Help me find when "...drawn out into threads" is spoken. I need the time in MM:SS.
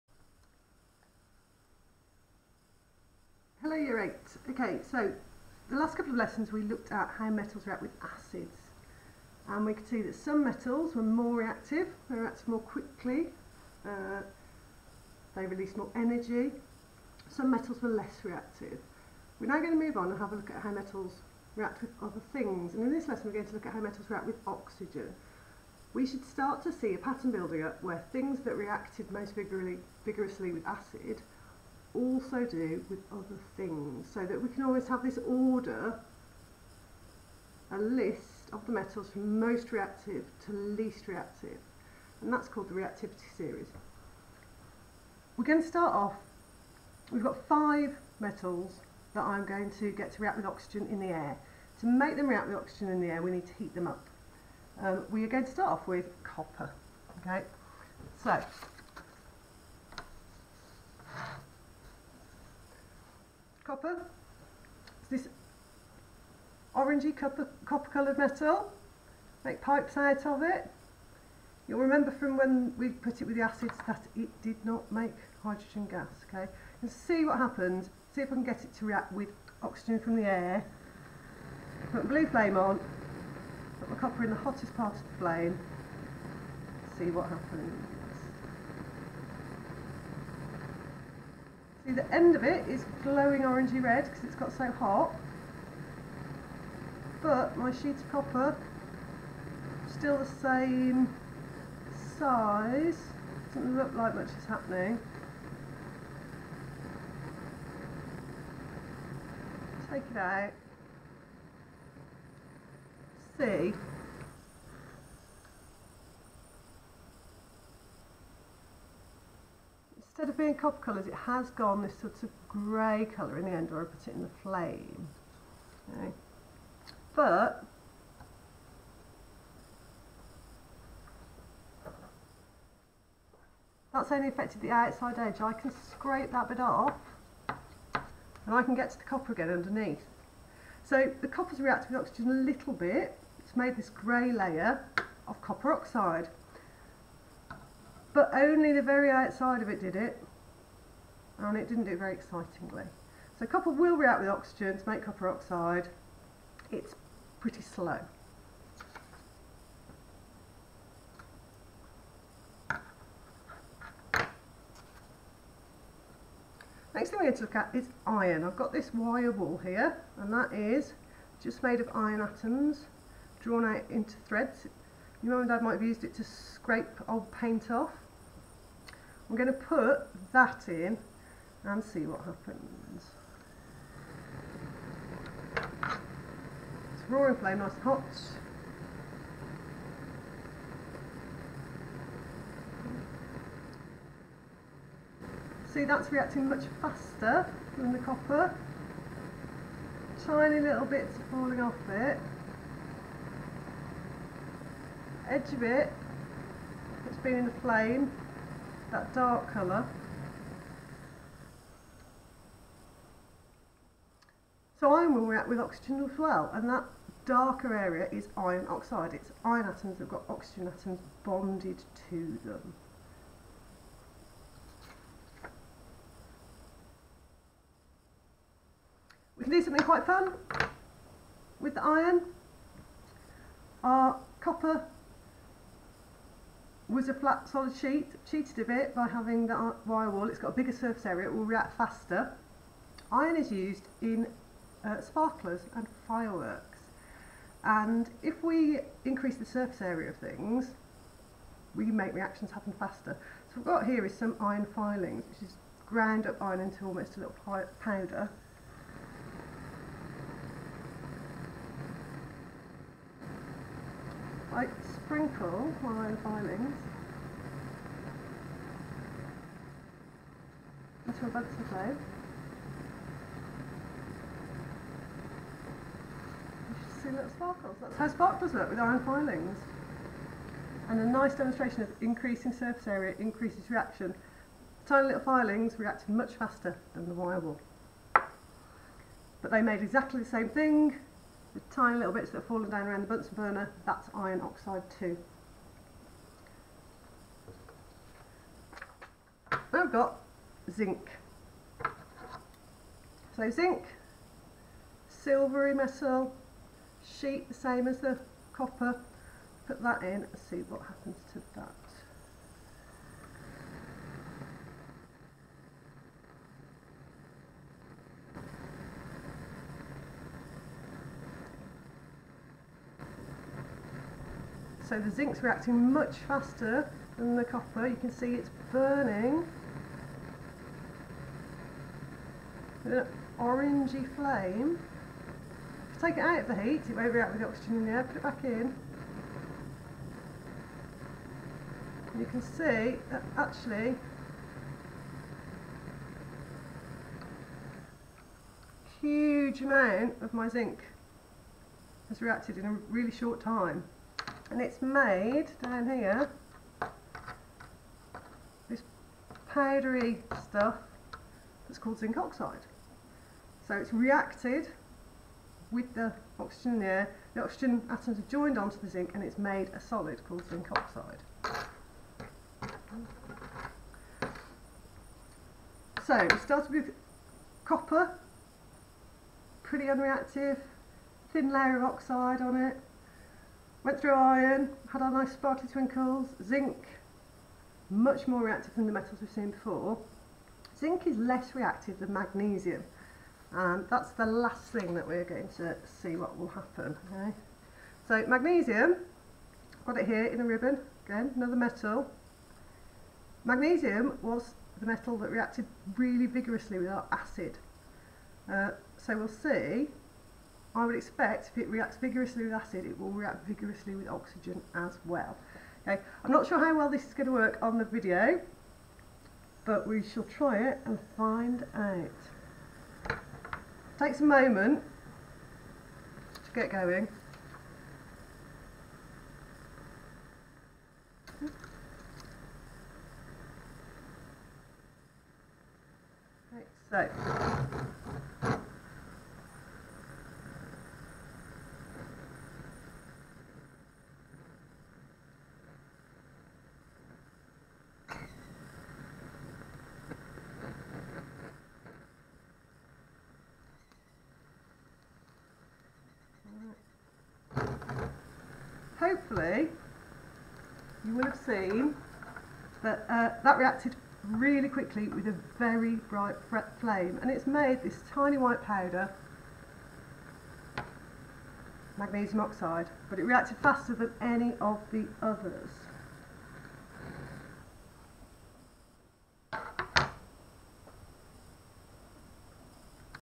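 02:53.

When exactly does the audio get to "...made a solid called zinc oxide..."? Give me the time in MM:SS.
06:09.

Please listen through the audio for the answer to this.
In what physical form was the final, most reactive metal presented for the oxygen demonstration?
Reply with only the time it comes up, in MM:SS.
06:40.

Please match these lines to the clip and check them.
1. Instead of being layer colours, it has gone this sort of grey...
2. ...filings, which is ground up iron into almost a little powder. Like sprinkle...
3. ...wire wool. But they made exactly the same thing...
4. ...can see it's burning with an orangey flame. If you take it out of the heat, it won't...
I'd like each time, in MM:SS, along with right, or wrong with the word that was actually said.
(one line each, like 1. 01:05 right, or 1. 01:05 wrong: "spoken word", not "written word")
1. 02:00 wrong: "copper", not "layer"
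2. 04:14 right
3. 04:47 right
4. 05:27 right.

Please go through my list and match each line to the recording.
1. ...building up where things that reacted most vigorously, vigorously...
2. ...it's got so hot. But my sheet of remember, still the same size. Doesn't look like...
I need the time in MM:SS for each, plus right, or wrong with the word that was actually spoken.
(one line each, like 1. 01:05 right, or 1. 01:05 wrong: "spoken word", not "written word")
1. 00:27 right
2. 01:34 wrong: "copper", not "remember".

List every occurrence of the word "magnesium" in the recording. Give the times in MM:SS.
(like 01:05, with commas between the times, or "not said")
06:32, 06:38, 06:43, 07:51.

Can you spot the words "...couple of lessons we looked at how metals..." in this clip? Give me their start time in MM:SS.
00:05.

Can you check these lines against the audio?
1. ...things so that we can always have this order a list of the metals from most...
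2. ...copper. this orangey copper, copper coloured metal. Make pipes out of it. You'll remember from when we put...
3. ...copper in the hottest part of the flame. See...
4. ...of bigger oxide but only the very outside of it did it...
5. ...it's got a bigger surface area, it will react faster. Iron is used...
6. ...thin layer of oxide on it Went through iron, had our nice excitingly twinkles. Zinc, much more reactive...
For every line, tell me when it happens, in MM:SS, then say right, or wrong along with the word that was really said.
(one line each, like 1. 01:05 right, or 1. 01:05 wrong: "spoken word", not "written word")
1. 00:33 right
2. 01:03 right
3. 01:23 right
4. 02:25 wrong: "copper", not "bigger"
5. 04:00 right
6. 06:21 wrong: "sparkly", not "excitingly".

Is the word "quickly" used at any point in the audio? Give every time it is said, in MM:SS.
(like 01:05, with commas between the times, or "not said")
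00:12, 07:44.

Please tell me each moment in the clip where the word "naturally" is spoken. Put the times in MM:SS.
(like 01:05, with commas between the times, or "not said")
not said.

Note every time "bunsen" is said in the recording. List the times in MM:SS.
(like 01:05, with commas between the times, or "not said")
04:31, 04:53.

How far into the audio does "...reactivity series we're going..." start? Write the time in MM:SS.
00:42.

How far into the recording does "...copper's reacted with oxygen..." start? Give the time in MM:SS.
02:21.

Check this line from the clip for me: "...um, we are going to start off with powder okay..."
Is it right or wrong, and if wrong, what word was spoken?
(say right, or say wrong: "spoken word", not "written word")
wrong: "copper", not "powder".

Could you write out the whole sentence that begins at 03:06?
It's roaring flame, nice and hot.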